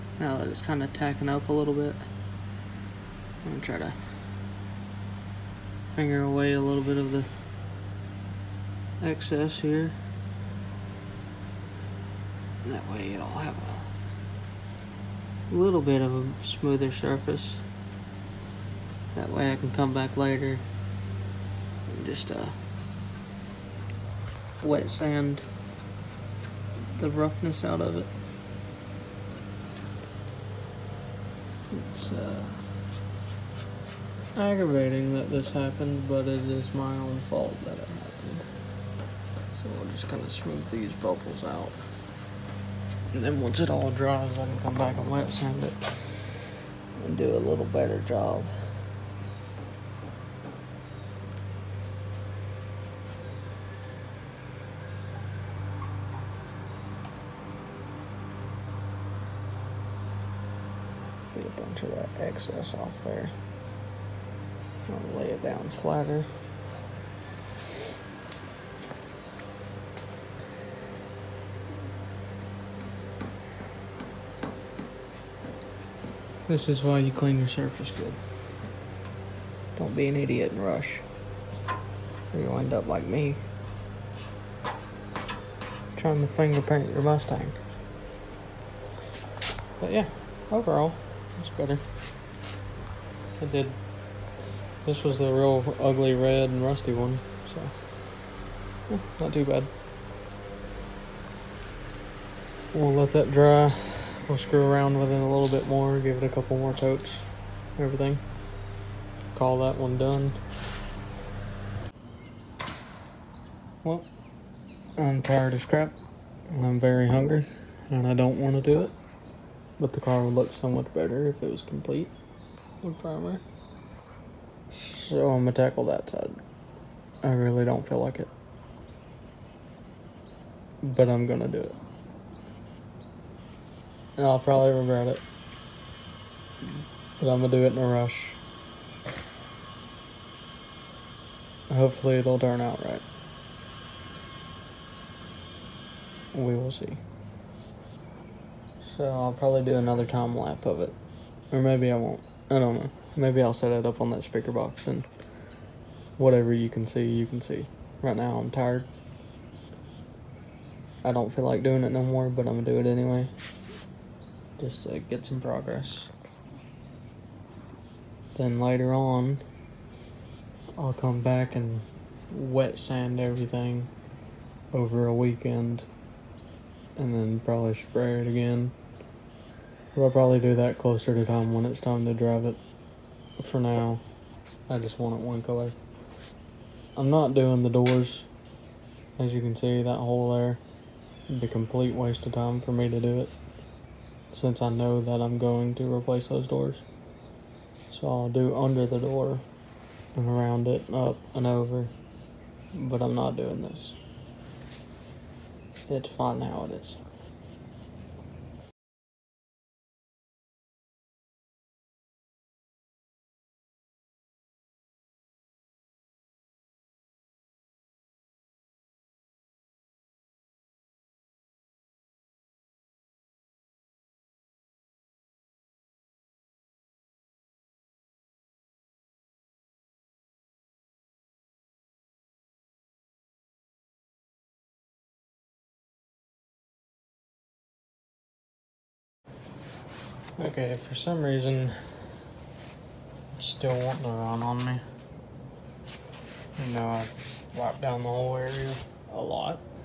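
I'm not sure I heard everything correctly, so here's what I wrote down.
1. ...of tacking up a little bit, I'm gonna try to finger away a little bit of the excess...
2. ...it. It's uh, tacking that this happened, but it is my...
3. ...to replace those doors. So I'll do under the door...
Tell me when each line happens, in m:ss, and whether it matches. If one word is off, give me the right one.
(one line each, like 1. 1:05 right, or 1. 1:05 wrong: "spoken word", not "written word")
1. 0:00 right
2. 0:27 wrong: "aggravating", not "tacking"
3. 3:15 right.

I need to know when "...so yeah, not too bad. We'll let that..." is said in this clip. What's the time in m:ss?
1:37.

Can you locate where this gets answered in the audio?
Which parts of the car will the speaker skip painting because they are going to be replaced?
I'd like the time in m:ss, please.
3:07.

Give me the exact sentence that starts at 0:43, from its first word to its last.
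And then once it all dries, I can come back and wet sand it and do a little better job.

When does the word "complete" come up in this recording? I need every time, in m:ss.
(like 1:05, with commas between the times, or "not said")
2:01, 3:11.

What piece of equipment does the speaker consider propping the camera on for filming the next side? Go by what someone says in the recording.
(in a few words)
speaker box.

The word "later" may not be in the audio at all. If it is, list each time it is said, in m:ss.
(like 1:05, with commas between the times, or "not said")
0:20, 2:48.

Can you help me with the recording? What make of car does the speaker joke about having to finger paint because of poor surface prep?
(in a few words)
Mustang.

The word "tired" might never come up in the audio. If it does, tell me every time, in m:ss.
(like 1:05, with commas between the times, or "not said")
1:55, 2:38.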